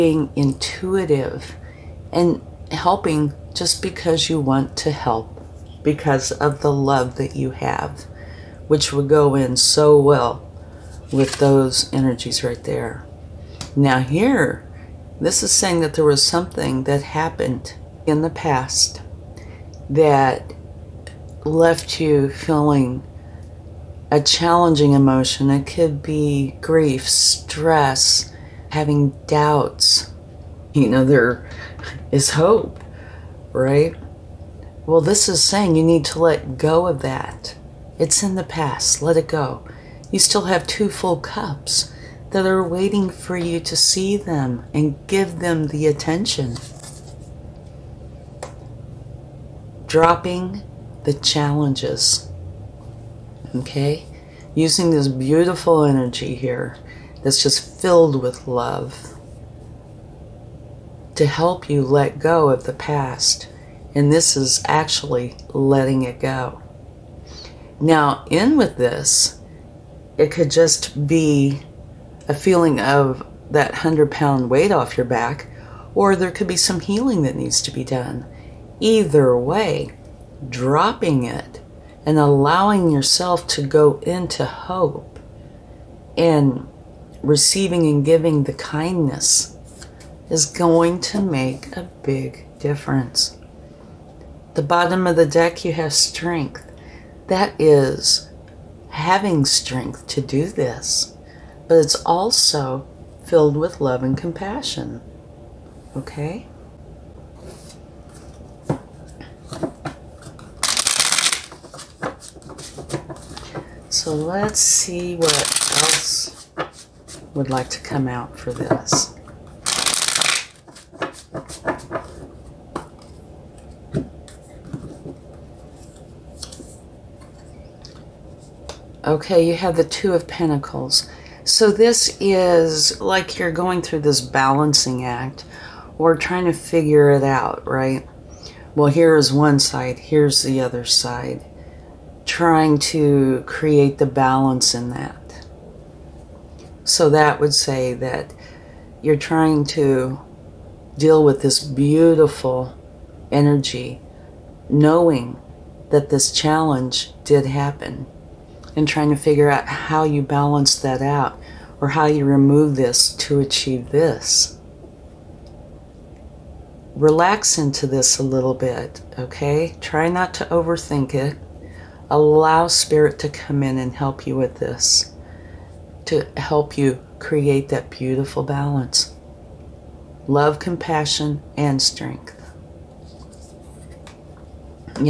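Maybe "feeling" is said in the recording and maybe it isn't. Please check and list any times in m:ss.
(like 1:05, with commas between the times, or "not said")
0:22, 1:12.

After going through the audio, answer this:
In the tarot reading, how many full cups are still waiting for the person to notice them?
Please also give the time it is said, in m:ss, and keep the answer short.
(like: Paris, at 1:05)
2, at 0:40.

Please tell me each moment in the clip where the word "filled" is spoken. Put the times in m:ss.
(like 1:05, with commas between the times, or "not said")
0:57, 1:43.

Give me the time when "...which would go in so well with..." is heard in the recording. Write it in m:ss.
0:08.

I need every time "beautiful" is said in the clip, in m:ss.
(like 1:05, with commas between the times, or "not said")
0:55, 2:31, 2:57.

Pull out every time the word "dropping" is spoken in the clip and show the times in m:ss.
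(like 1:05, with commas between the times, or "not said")
0:49, 1:20.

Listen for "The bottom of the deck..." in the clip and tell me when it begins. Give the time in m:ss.
1:34.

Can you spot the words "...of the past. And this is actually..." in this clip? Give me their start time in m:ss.
1:02.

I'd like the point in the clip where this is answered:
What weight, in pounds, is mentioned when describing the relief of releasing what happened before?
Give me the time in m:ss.
1:13.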